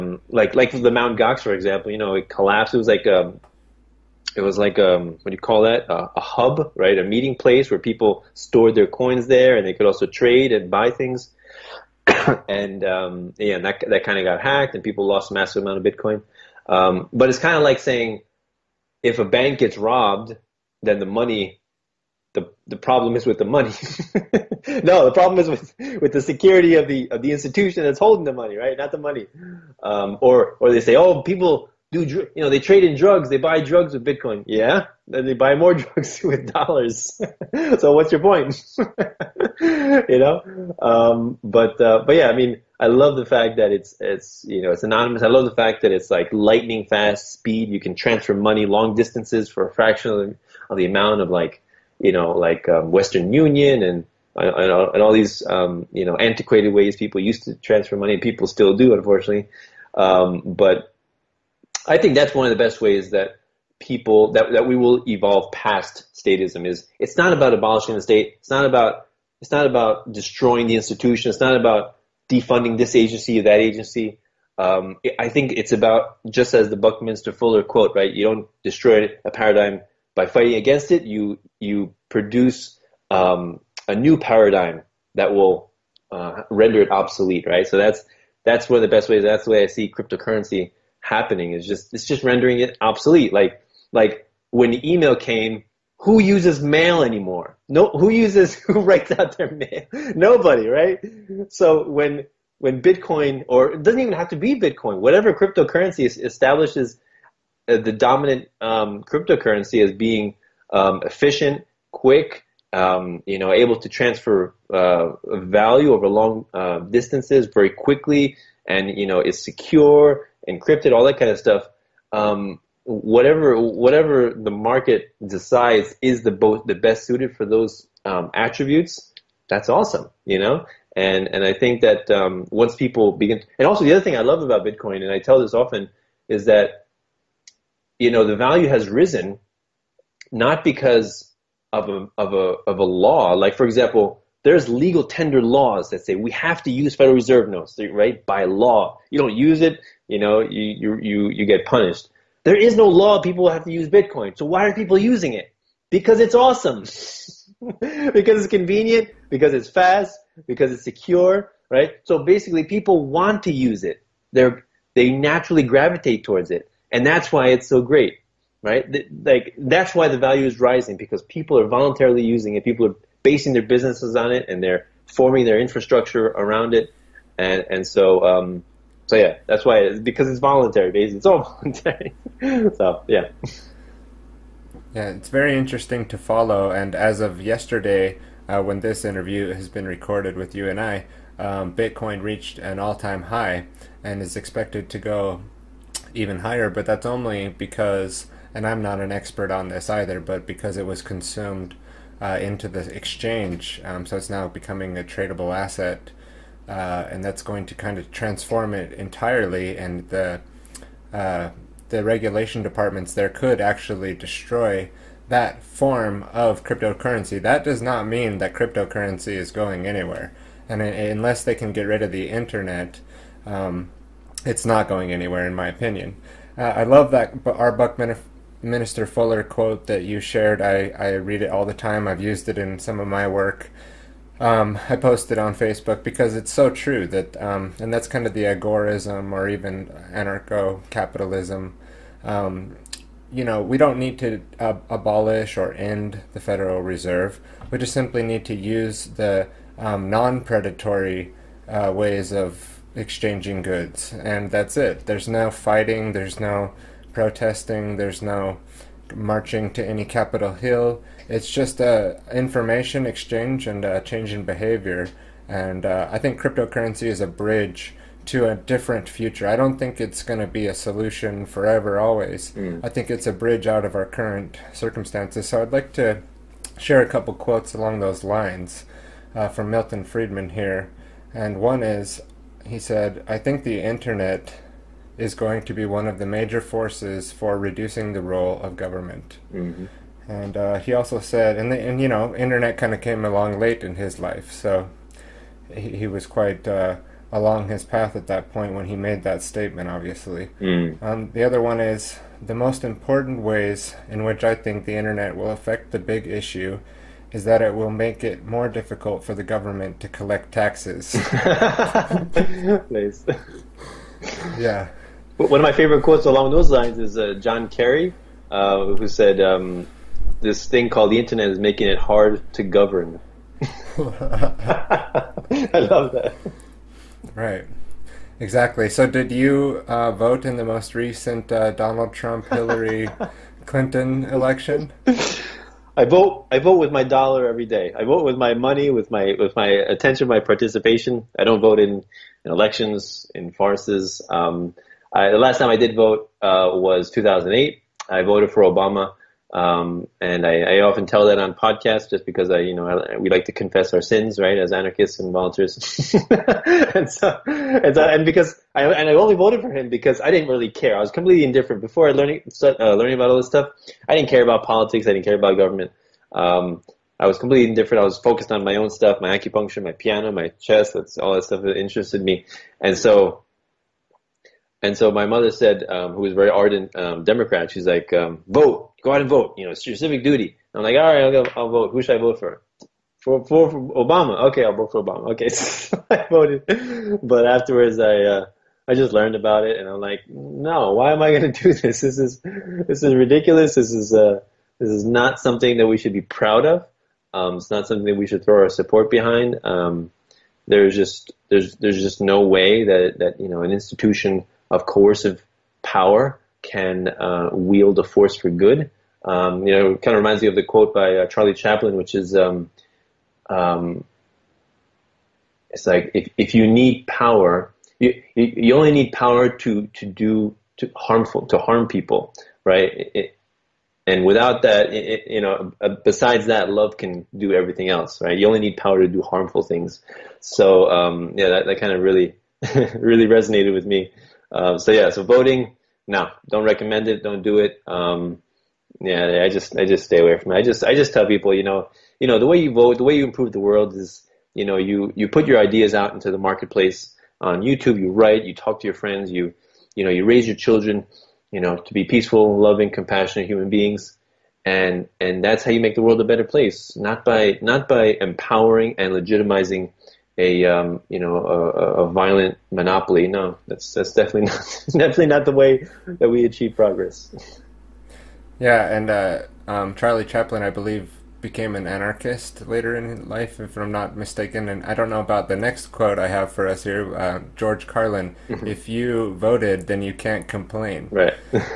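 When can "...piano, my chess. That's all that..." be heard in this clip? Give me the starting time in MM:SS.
06:09.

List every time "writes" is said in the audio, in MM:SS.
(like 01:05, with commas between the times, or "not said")
01:38, 07:28.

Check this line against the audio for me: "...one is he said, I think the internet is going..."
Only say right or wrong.
right.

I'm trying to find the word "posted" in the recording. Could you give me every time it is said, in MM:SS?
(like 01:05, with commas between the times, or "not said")
03:54.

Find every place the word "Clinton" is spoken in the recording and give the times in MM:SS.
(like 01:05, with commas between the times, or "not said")
05:33.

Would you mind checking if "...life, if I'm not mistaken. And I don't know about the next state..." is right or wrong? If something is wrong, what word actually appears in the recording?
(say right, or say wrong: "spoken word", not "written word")
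wrong: "quote", not "state".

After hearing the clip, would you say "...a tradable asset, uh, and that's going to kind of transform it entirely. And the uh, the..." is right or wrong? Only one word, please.
right.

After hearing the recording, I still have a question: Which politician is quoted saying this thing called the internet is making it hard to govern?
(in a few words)
John Kerry.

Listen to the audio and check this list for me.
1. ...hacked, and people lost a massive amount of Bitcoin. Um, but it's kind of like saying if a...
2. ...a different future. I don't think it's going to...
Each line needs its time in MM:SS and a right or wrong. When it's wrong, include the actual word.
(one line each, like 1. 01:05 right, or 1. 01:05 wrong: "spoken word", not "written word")
1. 00:14 right
2. 04:28 right.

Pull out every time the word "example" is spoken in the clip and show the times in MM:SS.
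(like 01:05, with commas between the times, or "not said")
00:01, 02:23.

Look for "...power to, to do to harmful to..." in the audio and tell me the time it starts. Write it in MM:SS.
06:59.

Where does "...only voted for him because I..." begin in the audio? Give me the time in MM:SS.
05:59.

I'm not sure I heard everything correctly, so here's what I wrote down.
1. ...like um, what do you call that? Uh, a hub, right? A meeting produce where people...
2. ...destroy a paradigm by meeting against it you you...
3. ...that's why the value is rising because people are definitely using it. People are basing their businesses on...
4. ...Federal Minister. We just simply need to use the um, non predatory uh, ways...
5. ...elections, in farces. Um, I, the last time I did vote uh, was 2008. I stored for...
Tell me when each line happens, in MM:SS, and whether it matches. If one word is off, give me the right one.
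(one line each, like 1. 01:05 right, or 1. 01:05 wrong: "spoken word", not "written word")
1. 00:04 wrong: "place", not "produce"
2. 01:18 wrong: "fighting", not "meeting"
3. 02:49 wrong: "voluntarily", not "definitely"
4. 04:06 wrong: "Reserve", not "Minister"
5. 05:42 wrong: "voted", not "stored".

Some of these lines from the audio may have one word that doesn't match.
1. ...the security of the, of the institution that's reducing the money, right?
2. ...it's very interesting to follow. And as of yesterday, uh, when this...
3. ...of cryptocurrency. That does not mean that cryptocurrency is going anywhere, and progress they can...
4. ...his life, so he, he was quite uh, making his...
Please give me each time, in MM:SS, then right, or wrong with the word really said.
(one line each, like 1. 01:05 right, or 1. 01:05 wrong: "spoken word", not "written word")
1. 00:26 wrong: "holding", not "reducing"
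2. 03:05 right
3. 03:36 wrong: "unless", not "progress"
4. 04:53 wrong: "along", not "making".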